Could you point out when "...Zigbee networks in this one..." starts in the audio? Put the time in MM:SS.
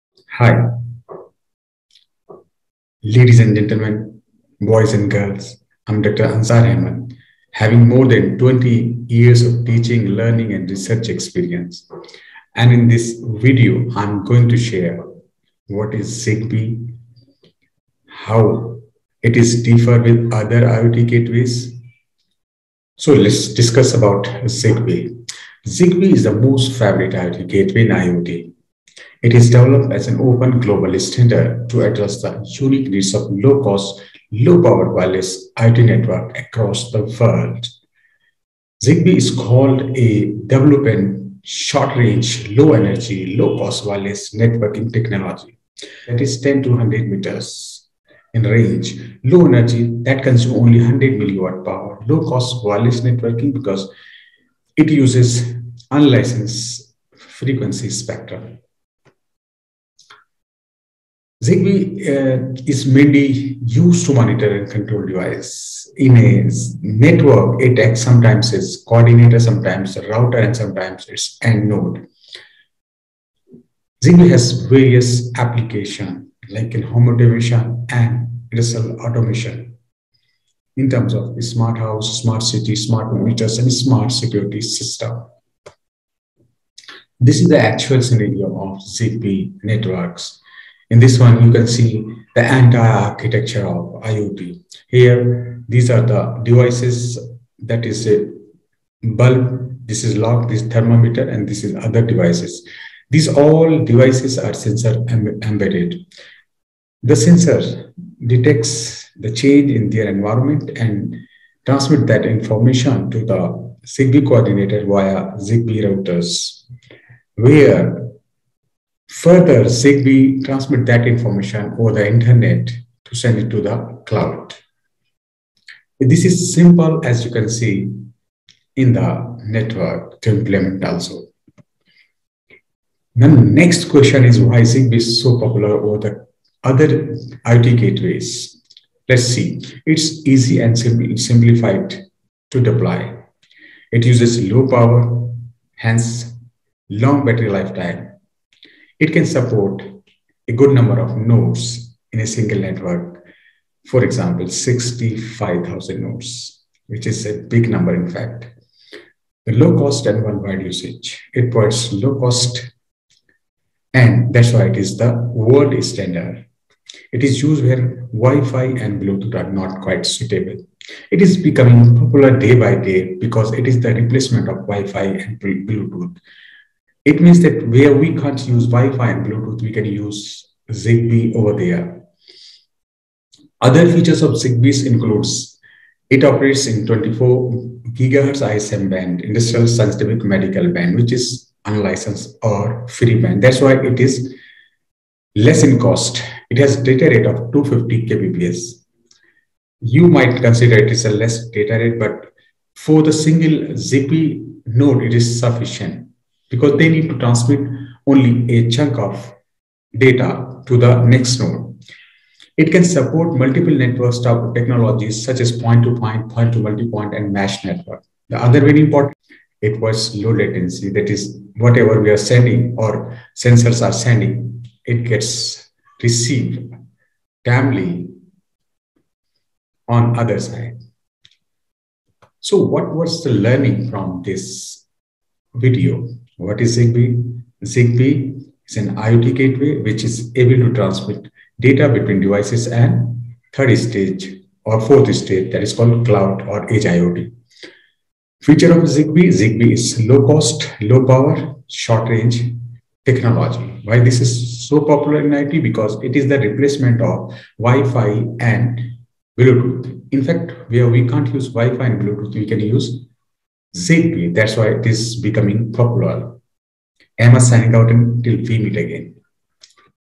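01:28.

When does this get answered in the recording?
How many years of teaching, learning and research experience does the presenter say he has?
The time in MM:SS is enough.
00:07.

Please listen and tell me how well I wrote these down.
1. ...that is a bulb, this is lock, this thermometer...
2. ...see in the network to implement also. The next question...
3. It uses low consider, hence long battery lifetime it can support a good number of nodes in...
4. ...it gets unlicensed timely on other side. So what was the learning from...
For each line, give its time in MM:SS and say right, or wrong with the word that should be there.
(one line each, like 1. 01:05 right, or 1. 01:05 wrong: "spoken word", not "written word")
1. 01:37 right
2. 02:07 right
3. 02:23 wrong: "power", not "consider"
4. 03:44 wrong: "received", not "unlicensed".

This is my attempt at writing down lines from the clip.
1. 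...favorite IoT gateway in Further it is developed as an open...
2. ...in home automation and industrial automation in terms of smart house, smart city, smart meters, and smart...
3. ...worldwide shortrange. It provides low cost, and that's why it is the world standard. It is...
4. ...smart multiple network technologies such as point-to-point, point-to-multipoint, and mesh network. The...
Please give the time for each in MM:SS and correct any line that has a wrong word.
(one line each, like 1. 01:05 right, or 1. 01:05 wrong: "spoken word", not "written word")
1. 00:26 wrong: "IoT", not "Further"
2. 01:16 right
3. 02:40 wrong: "usage", not "shortrange"
4. 03:32 wrong: "support", not "smart".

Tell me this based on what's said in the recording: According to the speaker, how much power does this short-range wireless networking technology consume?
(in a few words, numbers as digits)
100 milliwatts.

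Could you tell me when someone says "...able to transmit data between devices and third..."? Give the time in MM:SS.
04:00.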